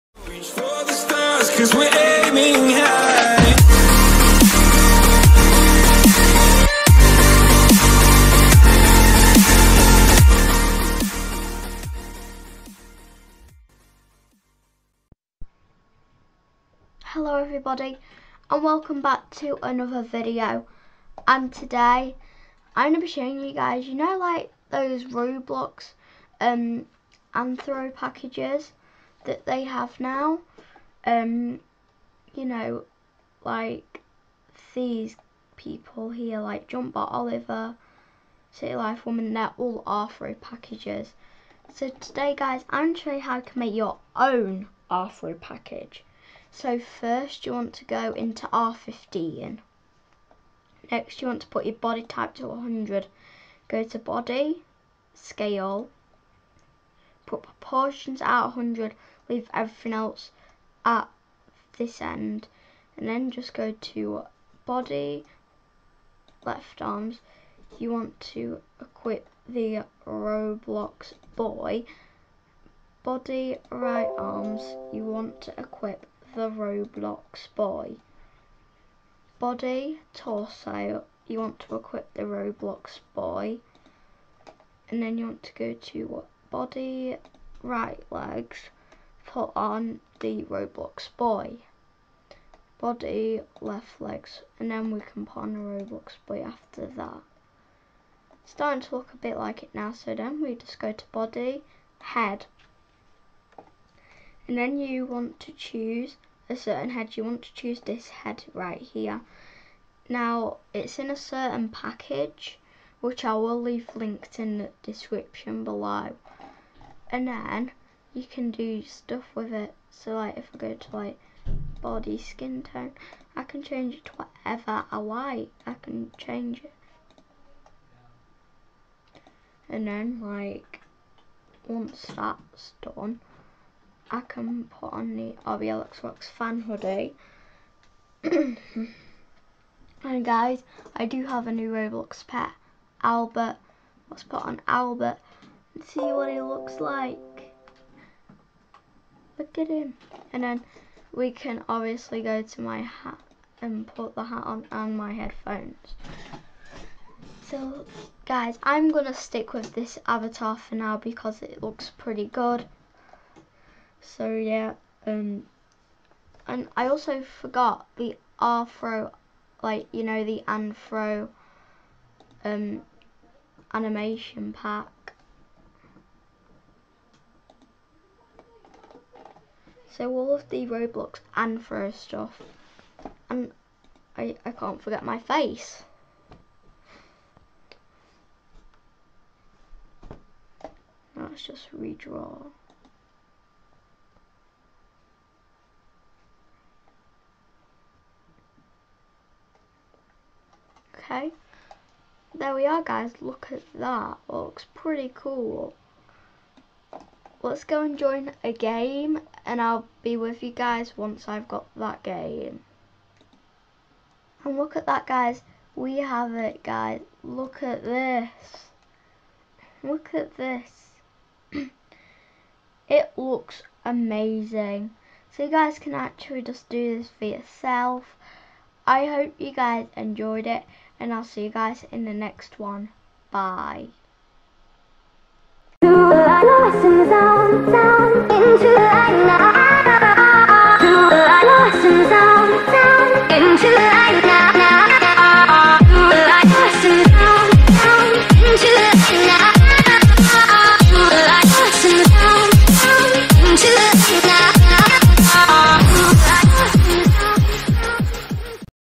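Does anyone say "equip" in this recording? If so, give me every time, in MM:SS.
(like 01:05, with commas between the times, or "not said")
01:08, 01:15, 01:21.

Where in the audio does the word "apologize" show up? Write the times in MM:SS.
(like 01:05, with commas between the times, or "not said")
not said.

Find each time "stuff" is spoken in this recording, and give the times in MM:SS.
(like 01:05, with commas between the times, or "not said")
01:58, 03:01.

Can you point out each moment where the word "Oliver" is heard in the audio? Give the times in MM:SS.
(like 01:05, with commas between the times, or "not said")
00:36.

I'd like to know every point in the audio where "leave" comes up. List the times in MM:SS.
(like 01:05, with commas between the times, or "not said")
00:59, 01:53.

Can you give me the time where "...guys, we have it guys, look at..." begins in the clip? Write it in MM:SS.
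03:35.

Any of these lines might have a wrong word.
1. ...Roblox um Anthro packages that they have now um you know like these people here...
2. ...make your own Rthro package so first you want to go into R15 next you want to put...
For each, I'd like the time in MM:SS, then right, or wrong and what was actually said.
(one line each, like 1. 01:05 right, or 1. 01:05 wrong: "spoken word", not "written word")
1. 00:25 right
2. 00:43 right.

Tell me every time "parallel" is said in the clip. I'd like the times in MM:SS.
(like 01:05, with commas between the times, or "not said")
not said.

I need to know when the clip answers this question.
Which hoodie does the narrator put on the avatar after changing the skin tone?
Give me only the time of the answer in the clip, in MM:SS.
02:15.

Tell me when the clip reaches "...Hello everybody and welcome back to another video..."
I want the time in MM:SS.
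00:17.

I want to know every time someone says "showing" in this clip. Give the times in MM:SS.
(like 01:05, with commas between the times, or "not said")
00:23, 00:42.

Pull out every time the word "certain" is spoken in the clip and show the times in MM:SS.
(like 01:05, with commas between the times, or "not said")
01:46, 01:51.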